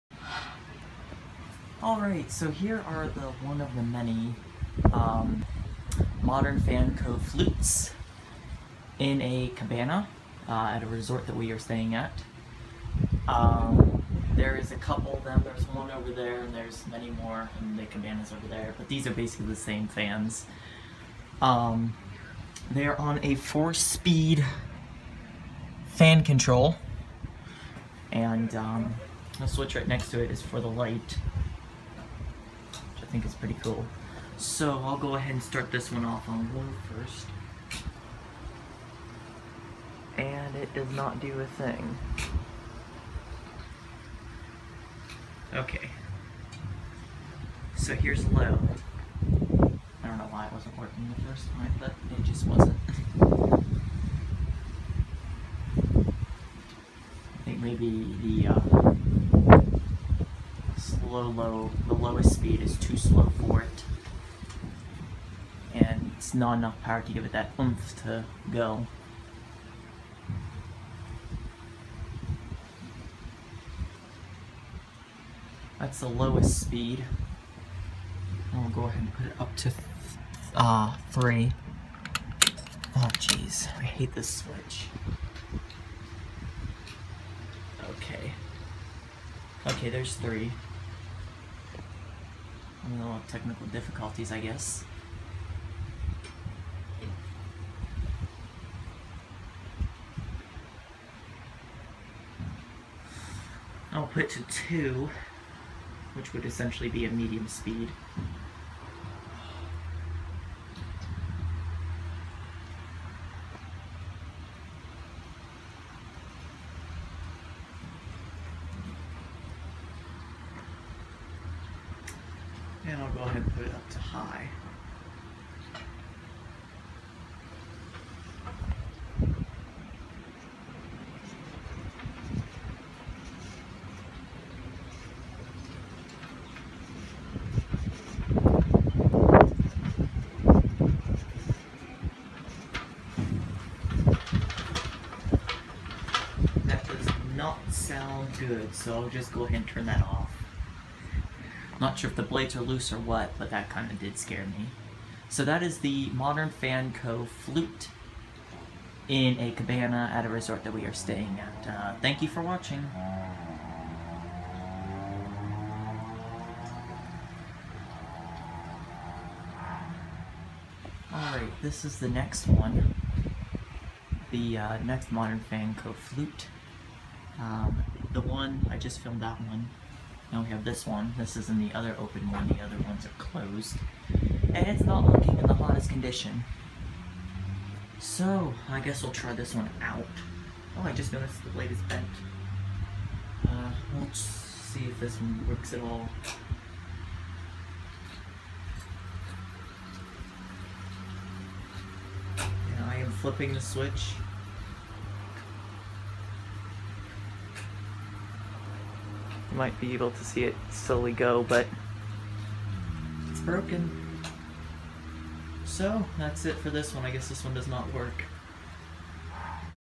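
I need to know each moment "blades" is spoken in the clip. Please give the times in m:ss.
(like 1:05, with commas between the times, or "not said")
2:32, 3:11.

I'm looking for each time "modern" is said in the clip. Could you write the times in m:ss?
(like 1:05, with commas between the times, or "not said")
0:06, 2:36, 2:55.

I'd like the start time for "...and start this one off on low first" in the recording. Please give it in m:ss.
0:35.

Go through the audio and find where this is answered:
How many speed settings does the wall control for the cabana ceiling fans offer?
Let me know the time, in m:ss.
0:23.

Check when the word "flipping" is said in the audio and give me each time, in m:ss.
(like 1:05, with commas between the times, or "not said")
3:23.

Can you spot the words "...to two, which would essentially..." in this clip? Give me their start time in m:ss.
1:44.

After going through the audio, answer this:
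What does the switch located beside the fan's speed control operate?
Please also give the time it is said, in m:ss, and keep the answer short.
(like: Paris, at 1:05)
The light, at 0:30.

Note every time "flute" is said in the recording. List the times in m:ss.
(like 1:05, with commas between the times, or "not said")
0:07, 2:37, 2:55.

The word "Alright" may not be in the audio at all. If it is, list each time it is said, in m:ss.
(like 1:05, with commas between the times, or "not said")
0:01, 2:51.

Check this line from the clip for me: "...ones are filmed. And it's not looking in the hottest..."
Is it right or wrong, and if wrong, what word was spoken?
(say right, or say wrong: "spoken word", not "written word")
wrong: "closed", not "filmed".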